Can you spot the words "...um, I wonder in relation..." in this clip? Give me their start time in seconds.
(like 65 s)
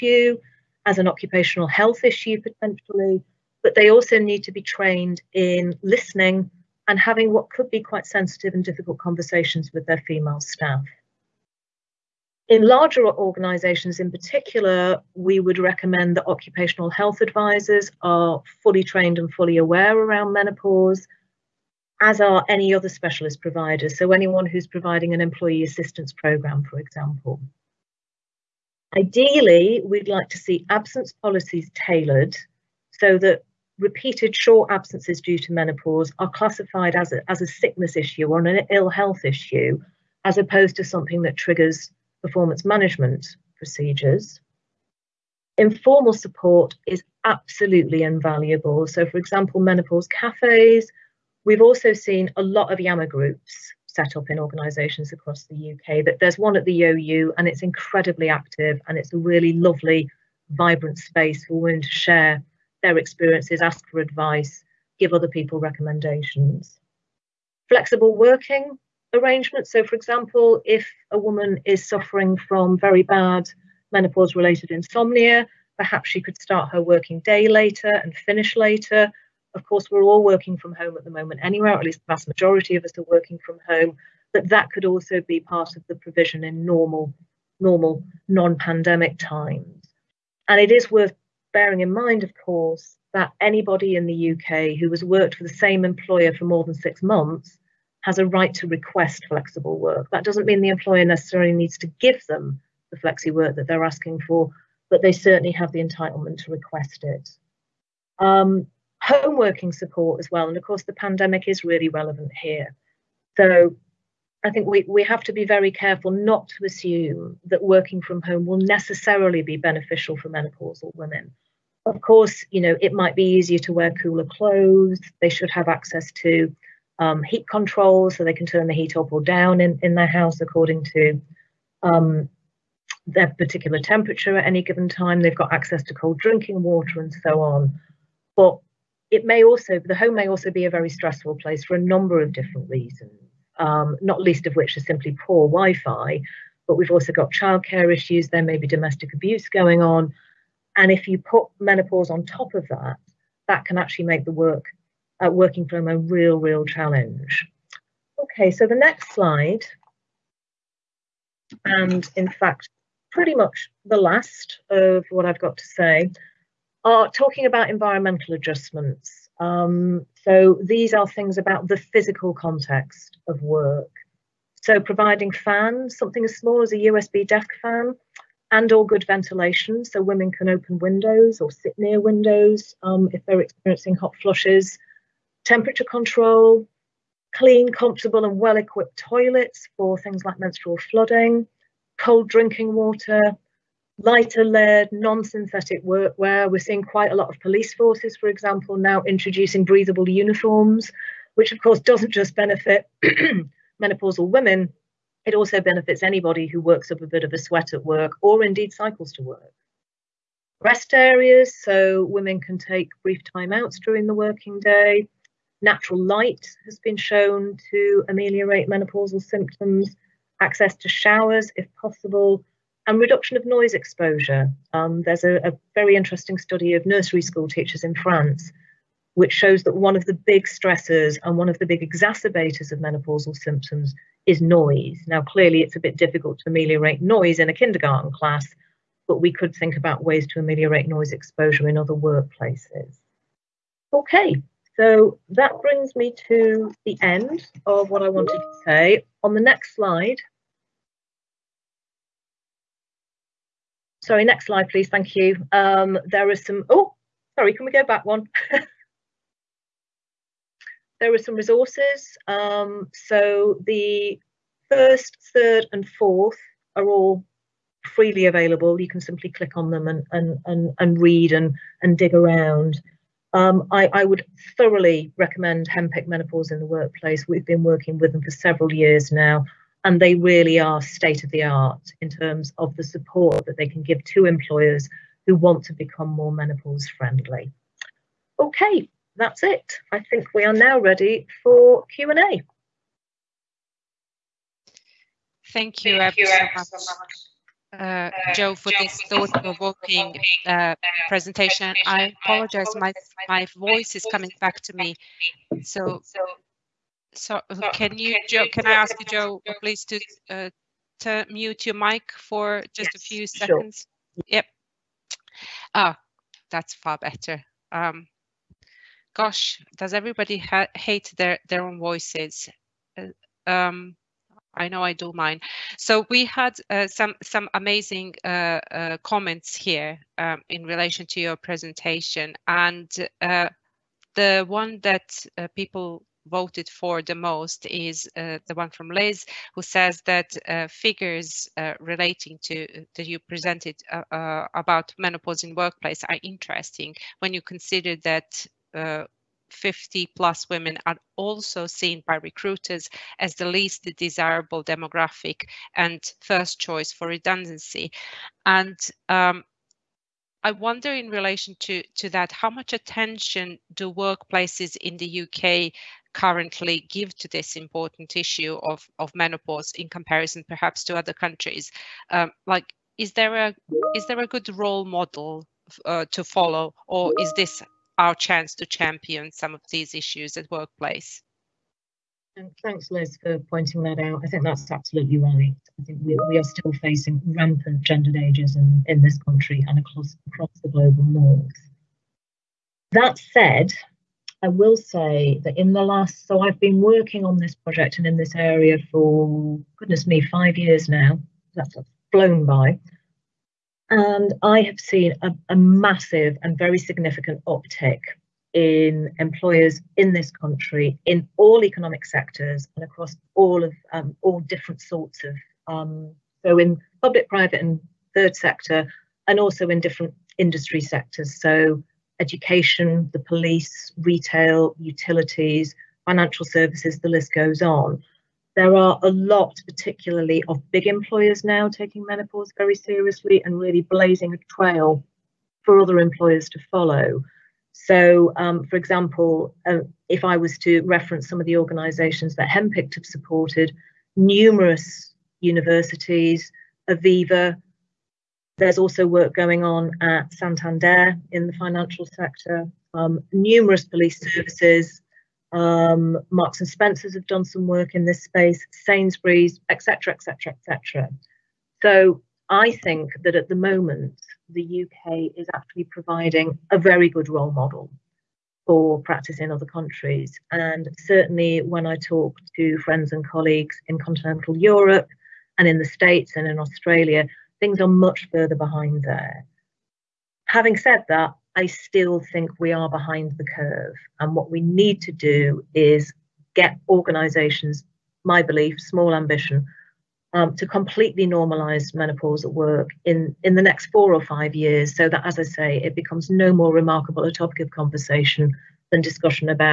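359 s.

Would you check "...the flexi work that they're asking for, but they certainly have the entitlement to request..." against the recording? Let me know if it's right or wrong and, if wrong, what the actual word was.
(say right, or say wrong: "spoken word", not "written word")
right.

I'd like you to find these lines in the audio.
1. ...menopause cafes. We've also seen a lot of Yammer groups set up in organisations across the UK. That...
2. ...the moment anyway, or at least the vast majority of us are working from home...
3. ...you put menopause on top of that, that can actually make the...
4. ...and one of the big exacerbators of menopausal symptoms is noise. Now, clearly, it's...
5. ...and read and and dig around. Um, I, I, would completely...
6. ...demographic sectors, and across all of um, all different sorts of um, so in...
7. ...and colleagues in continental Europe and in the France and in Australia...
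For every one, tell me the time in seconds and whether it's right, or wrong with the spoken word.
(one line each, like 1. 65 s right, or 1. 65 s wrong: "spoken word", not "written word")
1. 49 s right
2. 81 s right
3. 151 s right
4. 231 s right
5. 270 s wrong: "thoroughly", not "completely"
6. 411 s wrong: "economic", not "demographic"
7. 473 s wrong: "States", not "France".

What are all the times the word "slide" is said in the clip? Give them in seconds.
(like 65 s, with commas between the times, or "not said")
159 s, 249 s, 254 s.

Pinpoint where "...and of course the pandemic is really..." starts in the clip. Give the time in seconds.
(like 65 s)
110 s.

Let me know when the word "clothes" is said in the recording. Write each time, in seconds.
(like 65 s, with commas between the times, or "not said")
124 s.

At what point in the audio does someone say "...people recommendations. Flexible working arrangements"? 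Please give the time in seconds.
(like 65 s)
65 s.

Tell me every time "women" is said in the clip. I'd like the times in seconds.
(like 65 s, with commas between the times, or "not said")
61 s, 120 s, 180 s, 204 s, 212 s, 350 s.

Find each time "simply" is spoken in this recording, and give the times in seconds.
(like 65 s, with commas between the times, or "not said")
144 s, 269 s.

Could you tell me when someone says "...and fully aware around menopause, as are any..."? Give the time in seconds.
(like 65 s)
19 s.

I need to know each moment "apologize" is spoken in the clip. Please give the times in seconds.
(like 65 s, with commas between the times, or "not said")
302 s.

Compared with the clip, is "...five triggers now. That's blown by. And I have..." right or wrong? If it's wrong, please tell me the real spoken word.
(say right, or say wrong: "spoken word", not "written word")
wrong: "years", not "triggers".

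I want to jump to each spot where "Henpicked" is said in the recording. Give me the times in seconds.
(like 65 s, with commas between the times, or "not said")
275 s, 442 s.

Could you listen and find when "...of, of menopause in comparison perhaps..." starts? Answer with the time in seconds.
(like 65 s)
368 s.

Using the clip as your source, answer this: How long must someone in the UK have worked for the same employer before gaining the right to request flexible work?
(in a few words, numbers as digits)
6 months.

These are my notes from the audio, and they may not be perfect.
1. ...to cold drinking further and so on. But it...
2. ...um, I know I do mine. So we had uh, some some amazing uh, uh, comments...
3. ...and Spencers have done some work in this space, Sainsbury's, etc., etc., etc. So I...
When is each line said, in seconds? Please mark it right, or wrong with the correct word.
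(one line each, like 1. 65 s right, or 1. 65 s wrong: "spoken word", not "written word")
1. 135 s wrong: "water", not "further"
2. 323 s right
3. 456 s right.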